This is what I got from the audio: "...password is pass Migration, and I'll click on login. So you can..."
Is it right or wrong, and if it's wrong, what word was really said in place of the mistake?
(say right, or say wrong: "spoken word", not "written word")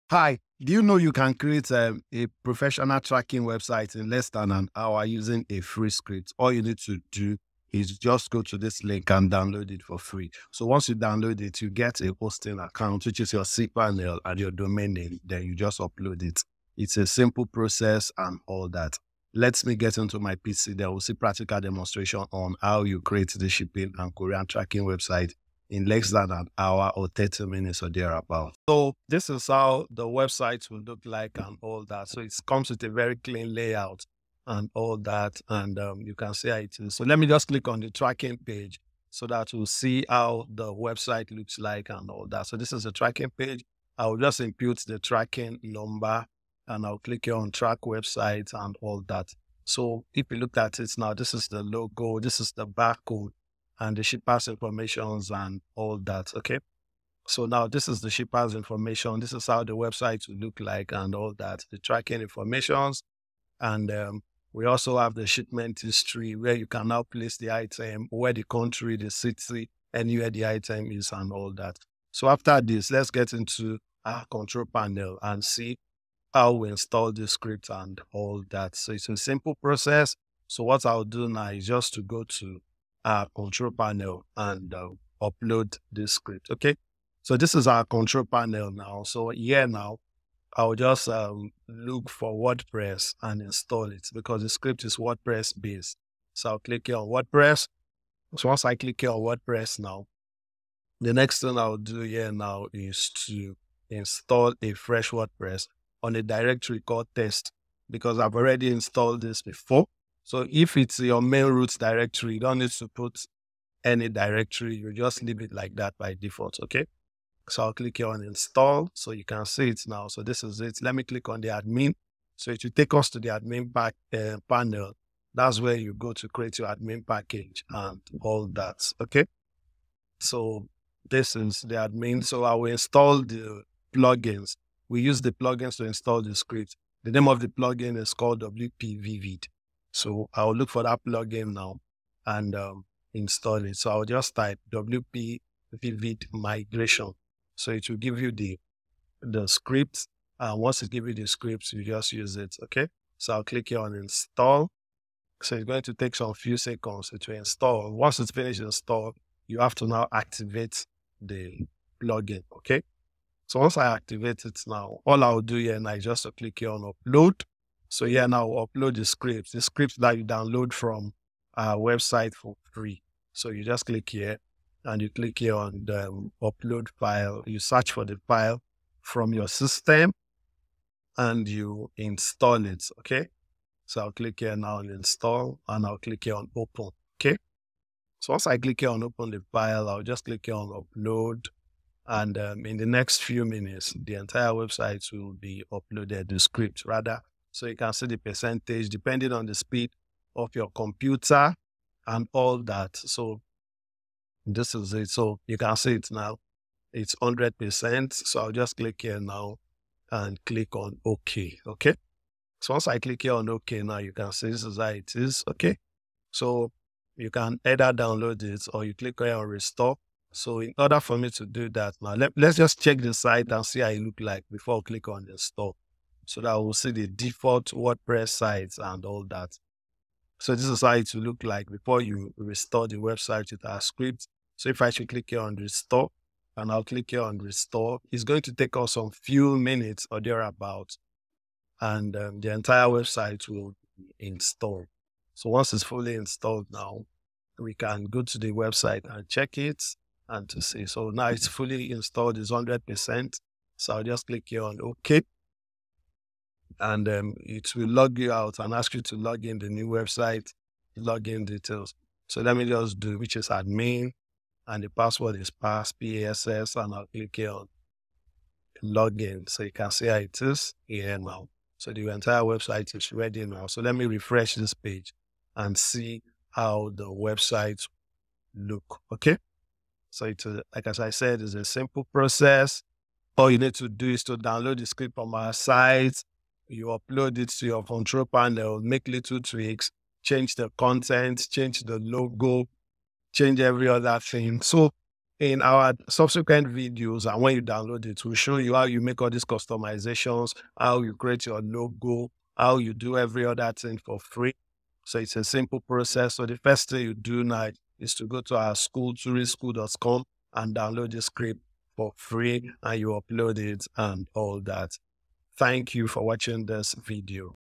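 wrong: "PASS", not "Migration".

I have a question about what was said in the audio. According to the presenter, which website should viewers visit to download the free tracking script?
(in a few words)
turischool.com.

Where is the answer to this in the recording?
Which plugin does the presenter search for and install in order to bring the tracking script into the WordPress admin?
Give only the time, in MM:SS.
02:18.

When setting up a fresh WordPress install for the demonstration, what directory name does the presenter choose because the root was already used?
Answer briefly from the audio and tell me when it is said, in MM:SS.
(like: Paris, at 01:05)
test, at 01:47.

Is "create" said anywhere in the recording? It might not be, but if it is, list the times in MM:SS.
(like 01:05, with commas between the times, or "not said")
00:01, 00:22, 02:06, 05:01.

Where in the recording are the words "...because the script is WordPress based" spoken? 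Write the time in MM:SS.
01:34.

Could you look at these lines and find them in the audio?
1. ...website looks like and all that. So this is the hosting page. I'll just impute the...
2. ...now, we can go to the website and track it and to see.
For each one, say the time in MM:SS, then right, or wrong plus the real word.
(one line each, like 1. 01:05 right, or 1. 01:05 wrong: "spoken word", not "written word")
1. 00:40 wrong: "tracking", not "hosting"
2. 04:06 wrong: "check", not "track".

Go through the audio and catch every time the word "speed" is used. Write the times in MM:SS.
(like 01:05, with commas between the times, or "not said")
03:19.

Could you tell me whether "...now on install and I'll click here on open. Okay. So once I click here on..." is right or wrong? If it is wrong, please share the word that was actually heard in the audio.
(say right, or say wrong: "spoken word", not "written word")
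right.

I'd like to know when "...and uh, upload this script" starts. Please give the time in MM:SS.
01:24.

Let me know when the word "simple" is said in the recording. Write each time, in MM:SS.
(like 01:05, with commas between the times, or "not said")
00:17, 01:19, 04:41, 05:05.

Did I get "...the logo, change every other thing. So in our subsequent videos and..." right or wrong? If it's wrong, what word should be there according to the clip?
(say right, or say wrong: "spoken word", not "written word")
right.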